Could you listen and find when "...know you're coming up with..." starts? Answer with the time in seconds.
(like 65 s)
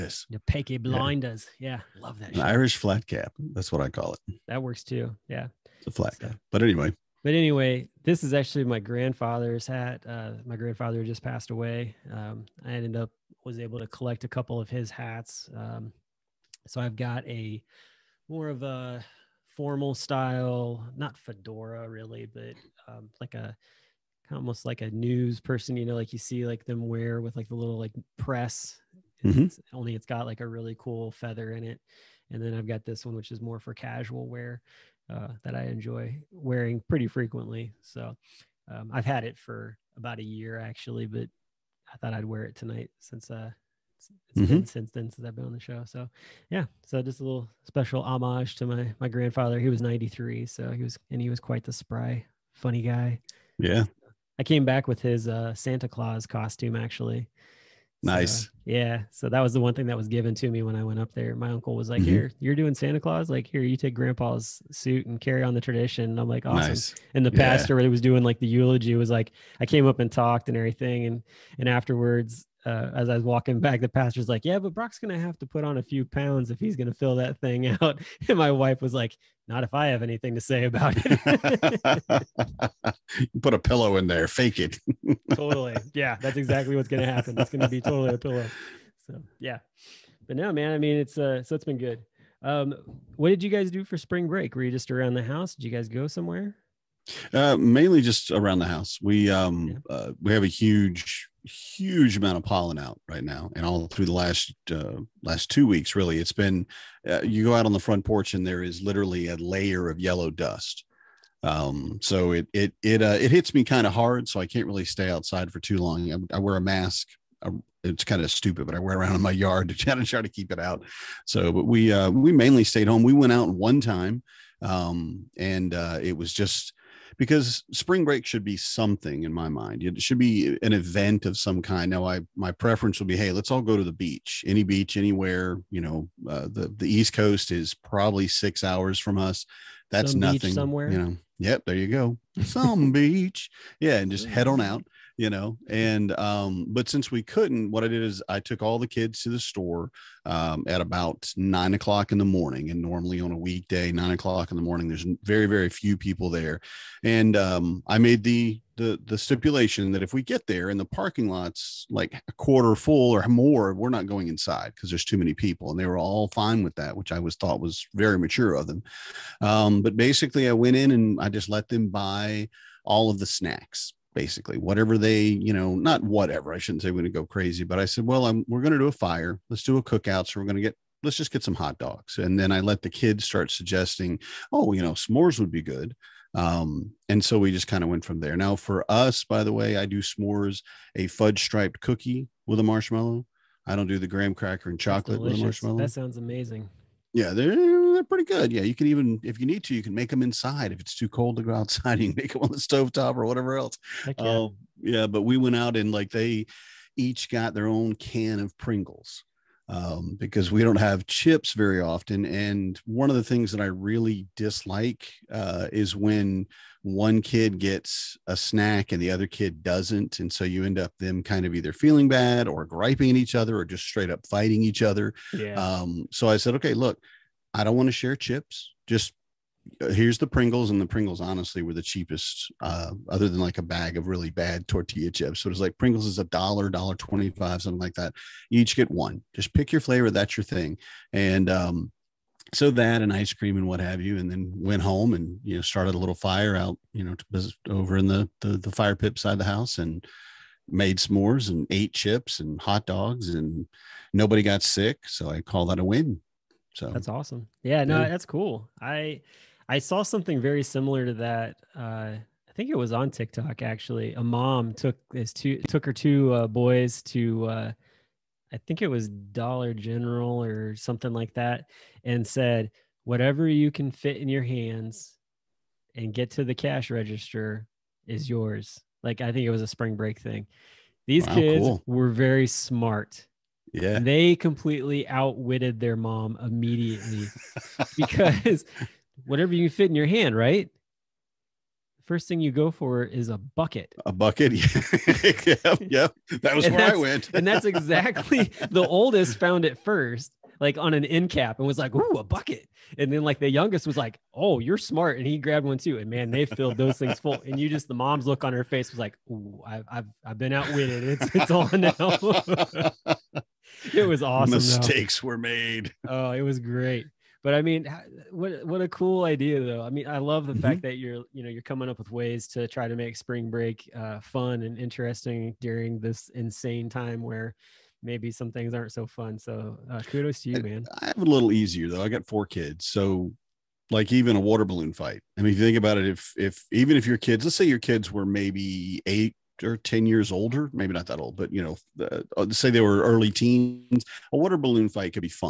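321 s.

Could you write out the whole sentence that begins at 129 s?
It should be an event of some kind.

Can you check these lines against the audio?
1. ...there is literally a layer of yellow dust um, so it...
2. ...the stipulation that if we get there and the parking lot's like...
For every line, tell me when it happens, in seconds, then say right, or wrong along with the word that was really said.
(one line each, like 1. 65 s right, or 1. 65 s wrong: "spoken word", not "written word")
1. 108 s right
2. 159 s right.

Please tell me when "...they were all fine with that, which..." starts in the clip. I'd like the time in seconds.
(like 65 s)
165 s.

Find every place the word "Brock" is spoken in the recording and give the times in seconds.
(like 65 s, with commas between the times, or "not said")
74 s.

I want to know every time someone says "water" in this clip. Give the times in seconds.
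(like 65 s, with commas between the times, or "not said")
334 s, 344 s.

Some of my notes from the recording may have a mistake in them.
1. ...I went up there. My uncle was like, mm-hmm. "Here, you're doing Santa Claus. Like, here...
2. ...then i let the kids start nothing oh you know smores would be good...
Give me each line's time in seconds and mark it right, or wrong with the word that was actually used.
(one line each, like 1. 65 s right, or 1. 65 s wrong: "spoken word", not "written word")
1. 60 s right
2. 182 s wrong: "suggesting", not "nothing".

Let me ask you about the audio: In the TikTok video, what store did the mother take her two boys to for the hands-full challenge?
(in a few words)
Dollar General.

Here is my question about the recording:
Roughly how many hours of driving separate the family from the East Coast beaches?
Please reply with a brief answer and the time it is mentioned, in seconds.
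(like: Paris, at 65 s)
6, at 138 s.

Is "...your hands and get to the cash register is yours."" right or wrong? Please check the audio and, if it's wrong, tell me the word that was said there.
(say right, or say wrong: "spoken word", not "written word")
right.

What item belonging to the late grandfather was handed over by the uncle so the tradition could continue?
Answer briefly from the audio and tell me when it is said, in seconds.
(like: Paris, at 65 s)
Santa Claus costume, at 55 s.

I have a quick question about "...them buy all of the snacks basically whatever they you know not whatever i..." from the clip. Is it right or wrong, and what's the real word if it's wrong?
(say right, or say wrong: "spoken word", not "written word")
right.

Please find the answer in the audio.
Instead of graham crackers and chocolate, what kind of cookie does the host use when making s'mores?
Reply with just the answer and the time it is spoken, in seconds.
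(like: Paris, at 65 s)
fudge striped cookie, at 191 s.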